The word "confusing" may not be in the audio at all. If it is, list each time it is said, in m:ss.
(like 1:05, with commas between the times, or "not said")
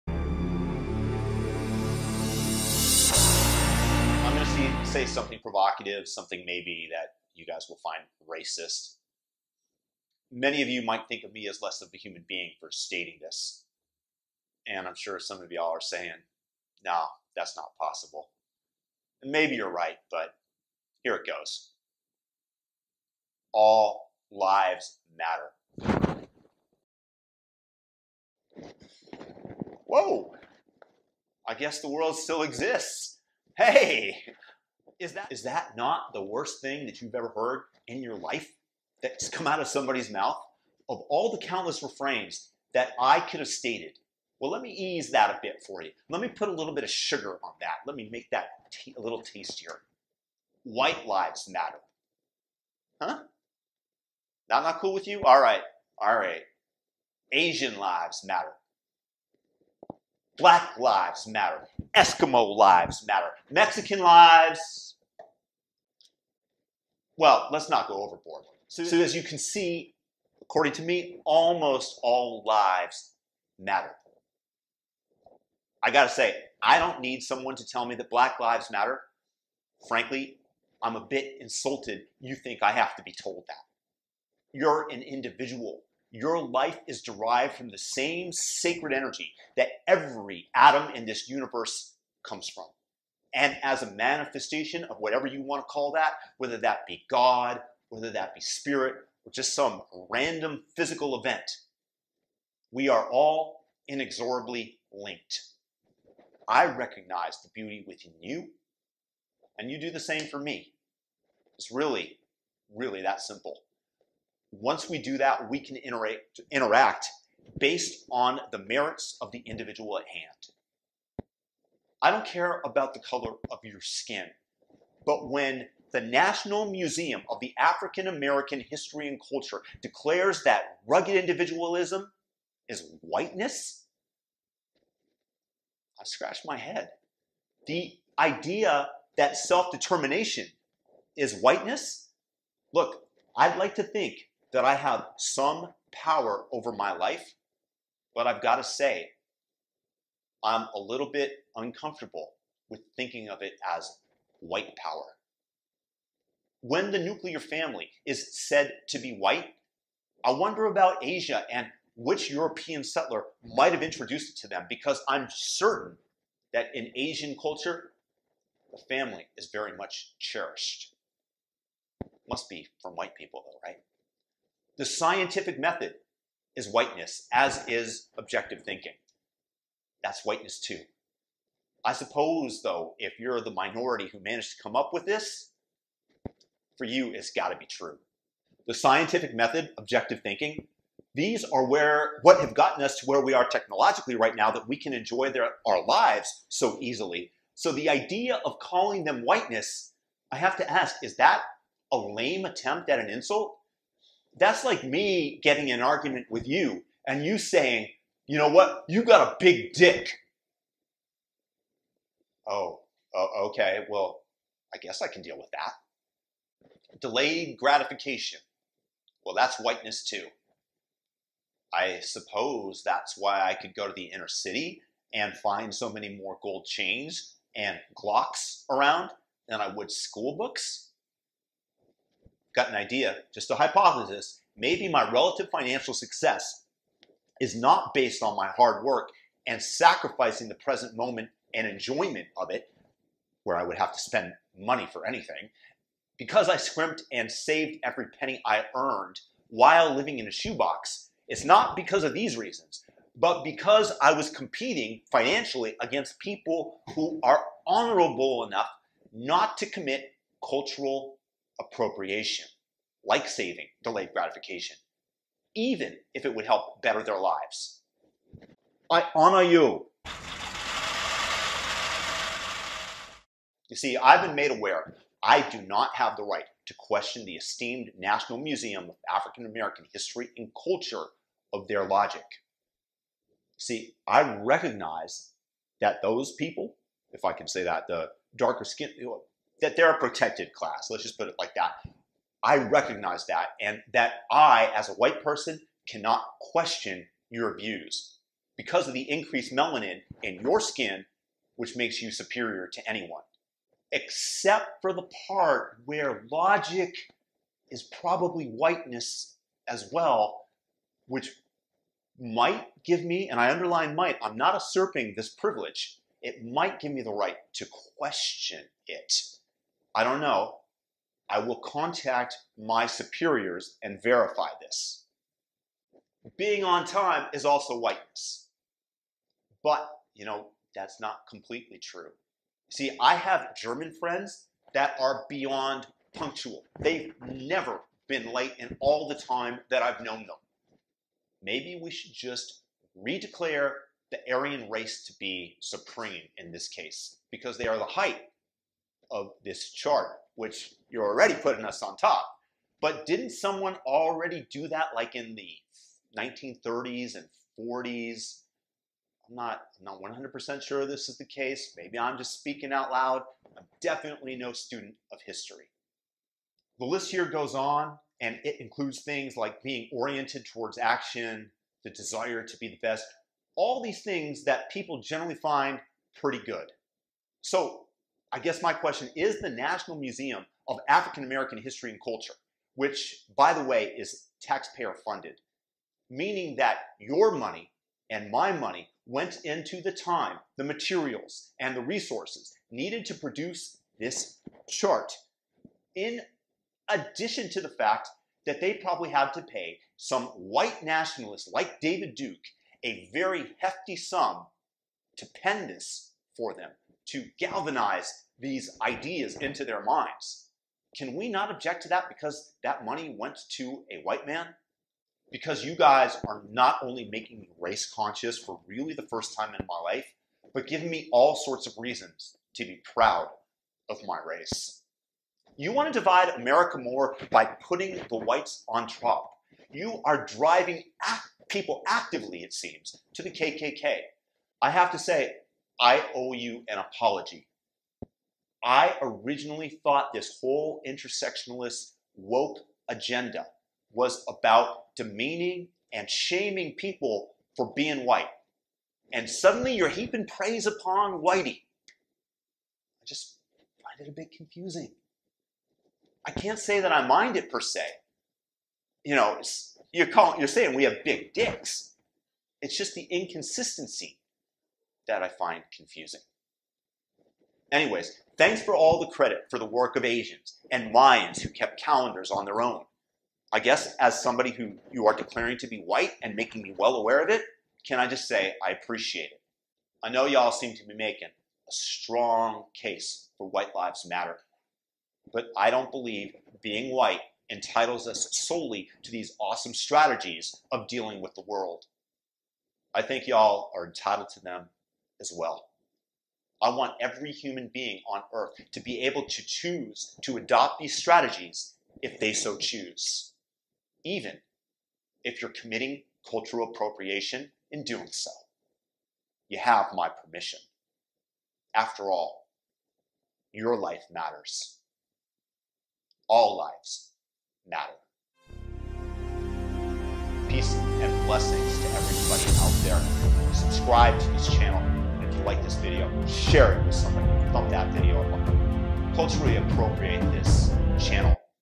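7:34, 7:45.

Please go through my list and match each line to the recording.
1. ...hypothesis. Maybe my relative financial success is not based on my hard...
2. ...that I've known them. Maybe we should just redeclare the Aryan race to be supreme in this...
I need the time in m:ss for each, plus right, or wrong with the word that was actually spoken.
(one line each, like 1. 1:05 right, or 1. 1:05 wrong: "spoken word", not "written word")
1. 3:53 right
2. 5:39 right.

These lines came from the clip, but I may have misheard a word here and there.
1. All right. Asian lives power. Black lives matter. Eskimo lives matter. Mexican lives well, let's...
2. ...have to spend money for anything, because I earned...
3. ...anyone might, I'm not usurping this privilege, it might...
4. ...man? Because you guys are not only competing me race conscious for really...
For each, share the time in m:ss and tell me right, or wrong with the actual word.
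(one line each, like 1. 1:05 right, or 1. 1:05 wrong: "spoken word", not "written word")
1. 0:55 wrong: "matter", not "power"
2. 4:03 wrong: "scrimped", not "earned"
3. 5:13 wrong: "underline", not "anyone"
4. 6:54 wrong: "making", not "competing".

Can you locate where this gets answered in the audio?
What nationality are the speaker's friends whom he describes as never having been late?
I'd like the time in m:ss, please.
5:33.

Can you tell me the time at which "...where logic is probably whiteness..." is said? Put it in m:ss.
5:05.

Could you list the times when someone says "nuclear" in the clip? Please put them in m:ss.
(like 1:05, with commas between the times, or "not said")
2:36.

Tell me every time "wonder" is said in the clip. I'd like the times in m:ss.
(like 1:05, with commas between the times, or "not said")
2:40.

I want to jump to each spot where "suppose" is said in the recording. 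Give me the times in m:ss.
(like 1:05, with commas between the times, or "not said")
3:01, 3:41.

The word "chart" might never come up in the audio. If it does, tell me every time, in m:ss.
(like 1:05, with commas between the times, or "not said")
5:49, 6:34.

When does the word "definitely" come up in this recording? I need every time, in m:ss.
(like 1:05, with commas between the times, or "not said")
6:03.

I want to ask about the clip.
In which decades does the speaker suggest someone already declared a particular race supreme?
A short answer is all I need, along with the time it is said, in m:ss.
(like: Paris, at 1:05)
1930s and 40s, at 5:56.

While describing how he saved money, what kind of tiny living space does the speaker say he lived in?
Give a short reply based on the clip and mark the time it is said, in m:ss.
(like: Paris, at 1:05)
a shoebox, at 4:10.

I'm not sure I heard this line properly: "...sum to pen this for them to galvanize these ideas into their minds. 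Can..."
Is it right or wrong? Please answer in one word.
right.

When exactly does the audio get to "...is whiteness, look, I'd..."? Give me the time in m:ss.
2:21.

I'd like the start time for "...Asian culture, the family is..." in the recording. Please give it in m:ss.
2:46.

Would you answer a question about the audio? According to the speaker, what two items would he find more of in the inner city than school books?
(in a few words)
gold chains and Glocks.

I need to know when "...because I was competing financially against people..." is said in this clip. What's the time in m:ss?
4:13.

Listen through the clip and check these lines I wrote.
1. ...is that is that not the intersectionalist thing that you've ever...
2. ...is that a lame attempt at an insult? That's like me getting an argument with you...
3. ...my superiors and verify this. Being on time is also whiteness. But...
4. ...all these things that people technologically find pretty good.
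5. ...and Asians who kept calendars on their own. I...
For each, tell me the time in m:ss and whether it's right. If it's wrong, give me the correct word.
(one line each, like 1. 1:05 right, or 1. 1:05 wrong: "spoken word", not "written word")
1. 0:35 wrong: "worst", not "intersectionalist"
2. 3:21 right
3. 5:22 right
4. 6:13 wrong: "generally", not "technologically"
5. 7:50 wrong: "Mayans", not "Asians".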